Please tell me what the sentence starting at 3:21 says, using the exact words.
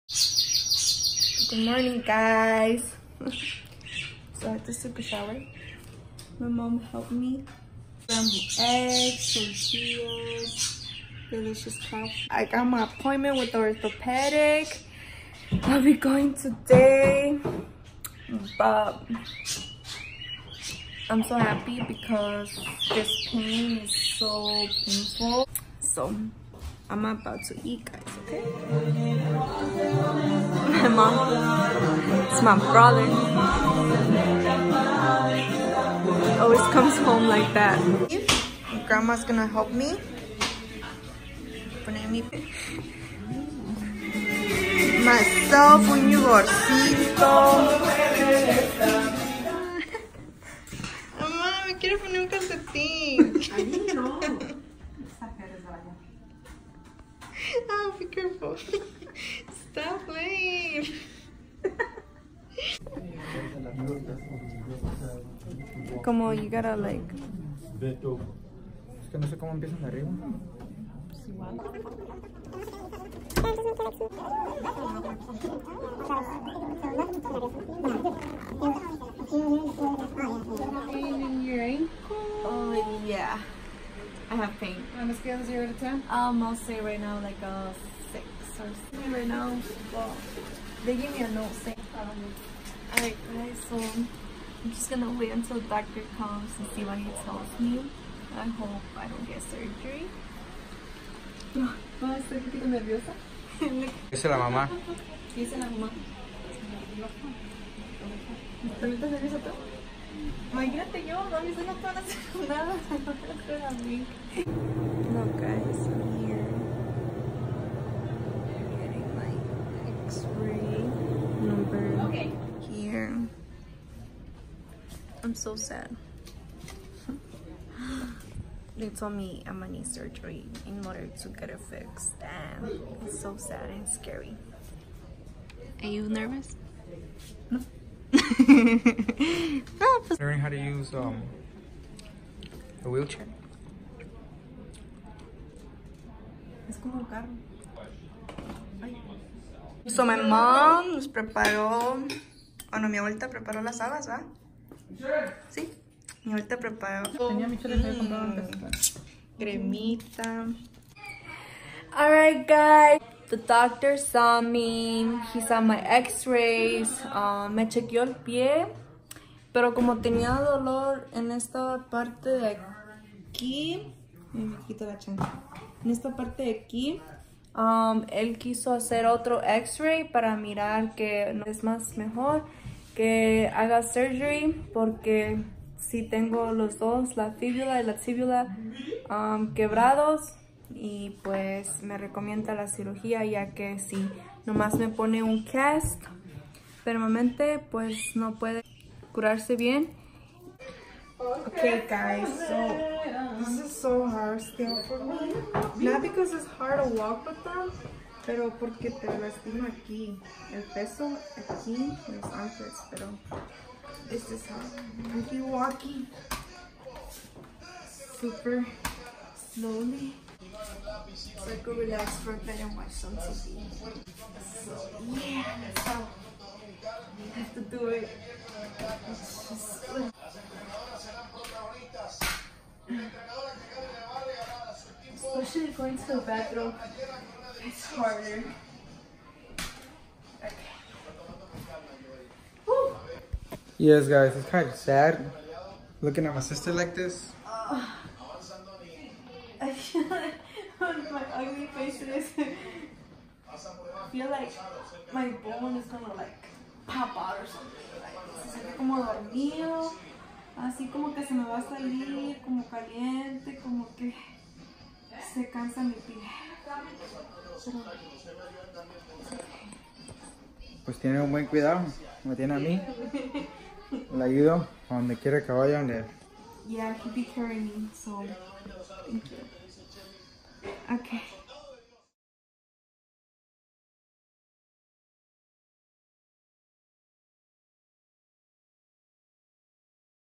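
Okay guys, so this is so hard still for me.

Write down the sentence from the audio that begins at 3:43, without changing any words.
So yeah, that's how I have to do it.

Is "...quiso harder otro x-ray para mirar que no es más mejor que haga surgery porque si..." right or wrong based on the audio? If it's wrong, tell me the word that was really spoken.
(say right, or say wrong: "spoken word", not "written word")
wrong: "hacer", not "harder".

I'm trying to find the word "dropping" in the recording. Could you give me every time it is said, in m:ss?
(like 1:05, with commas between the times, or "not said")
not said.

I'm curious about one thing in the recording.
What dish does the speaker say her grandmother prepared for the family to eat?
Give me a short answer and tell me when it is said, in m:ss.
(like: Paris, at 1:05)
habas, at 2:33.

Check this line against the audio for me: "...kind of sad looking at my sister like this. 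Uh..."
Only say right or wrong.
right.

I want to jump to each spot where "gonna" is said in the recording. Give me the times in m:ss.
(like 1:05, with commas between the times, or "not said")
0:39, 1:34, 2:09, 4:15.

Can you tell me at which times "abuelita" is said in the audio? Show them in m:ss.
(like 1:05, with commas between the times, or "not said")
2:32.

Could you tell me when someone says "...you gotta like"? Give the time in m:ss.
1:06.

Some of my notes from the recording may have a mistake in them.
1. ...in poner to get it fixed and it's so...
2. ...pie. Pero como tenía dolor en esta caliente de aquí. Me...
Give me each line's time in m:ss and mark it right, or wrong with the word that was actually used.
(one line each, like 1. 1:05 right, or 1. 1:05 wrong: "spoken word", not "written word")
1. 2:10 wrong: "order", not "poner"
2. 2:48 wrong: "parte", not "caliente".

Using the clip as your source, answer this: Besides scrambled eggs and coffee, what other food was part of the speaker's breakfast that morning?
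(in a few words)
tortillas.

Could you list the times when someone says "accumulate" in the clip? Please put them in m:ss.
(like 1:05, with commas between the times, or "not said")
not said.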